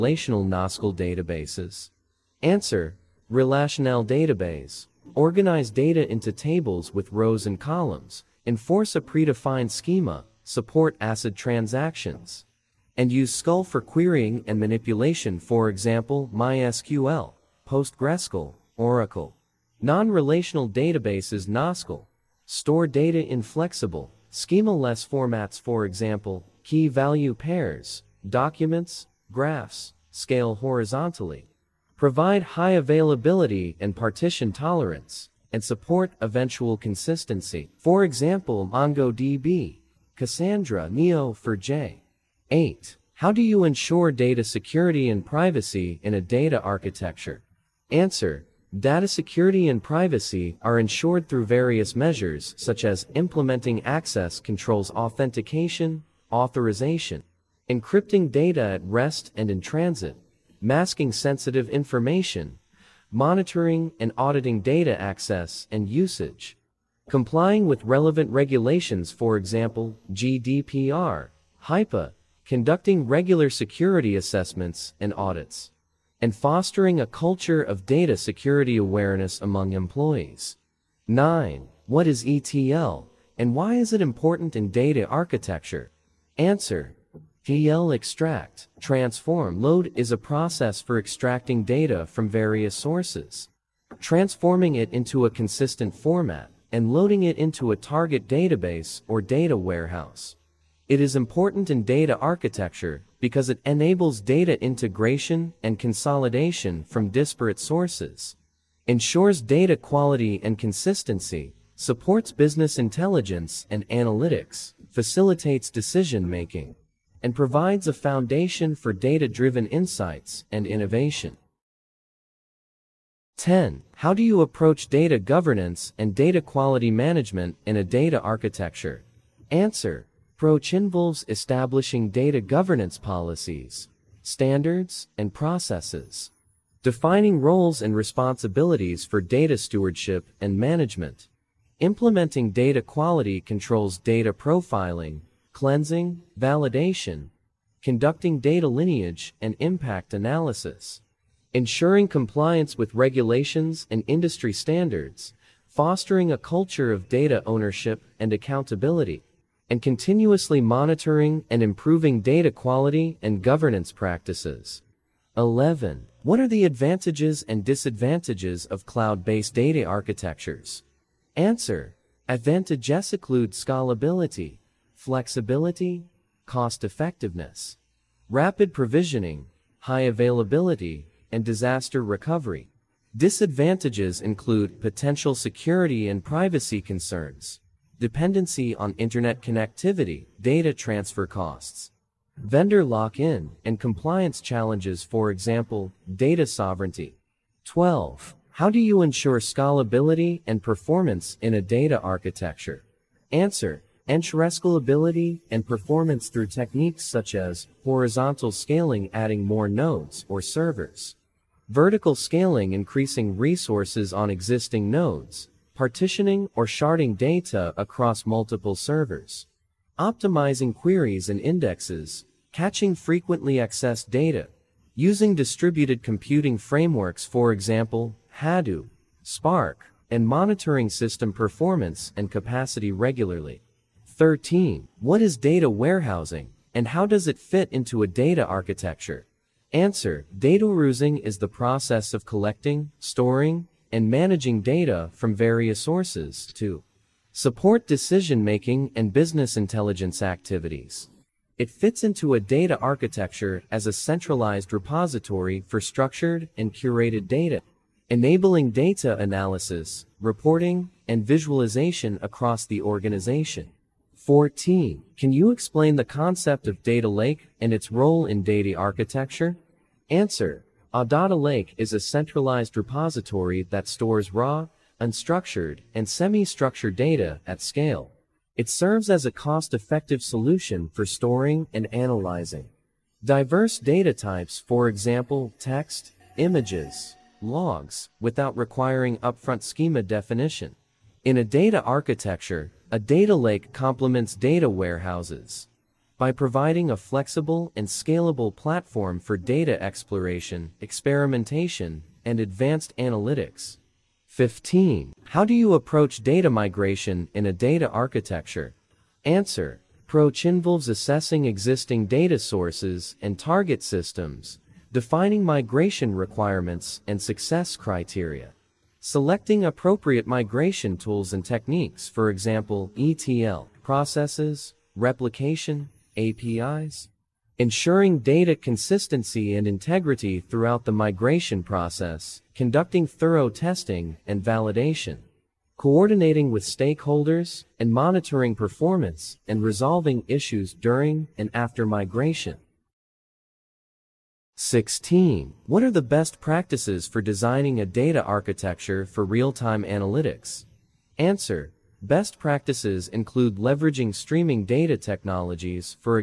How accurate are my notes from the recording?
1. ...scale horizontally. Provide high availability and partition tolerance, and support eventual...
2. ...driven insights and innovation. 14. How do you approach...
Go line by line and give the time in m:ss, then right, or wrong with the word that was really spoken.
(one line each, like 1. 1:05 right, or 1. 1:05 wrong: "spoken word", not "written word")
1. 0:30 right
2. 1:59 wrong: "10", not "14".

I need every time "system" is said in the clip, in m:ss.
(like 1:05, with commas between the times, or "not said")
3:50, 5:13.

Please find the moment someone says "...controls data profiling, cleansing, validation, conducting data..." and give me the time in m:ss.
2:23.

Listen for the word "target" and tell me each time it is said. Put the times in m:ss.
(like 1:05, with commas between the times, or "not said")
1:37, 5:13.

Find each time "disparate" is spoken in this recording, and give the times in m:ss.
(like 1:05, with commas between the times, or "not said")
1:47.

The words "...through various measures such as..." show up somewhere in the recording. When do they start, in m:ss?
0:51.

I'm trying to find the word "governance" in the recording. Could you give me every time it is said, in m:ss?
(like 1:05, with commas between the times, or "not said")
2:05, 2:12, 2:43.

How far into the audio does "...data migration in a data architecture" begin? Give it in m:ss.
5:06.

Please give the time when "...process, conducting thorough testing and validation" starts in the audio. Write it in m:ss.
5:31.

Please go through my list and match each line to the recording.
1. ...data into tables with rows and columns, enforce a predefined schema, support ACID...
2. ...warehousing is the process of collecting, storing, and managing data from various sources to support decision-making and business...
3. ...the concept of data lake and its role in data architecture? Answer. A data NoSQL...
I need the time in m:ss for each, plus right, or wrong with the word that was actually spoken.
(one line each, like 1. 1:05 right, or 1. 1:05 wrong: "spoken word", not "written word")
1. 0:05 right
2. 4:00 right
3. 4:25 wrong: "Lake", not "NoSQL".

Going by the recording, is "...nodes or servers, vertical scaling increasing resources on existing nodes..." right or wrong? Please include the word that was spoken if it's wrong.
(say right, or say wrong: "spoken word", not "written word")
right.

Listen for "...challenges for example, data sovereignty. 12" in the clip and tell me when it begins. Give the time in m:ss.
3:14.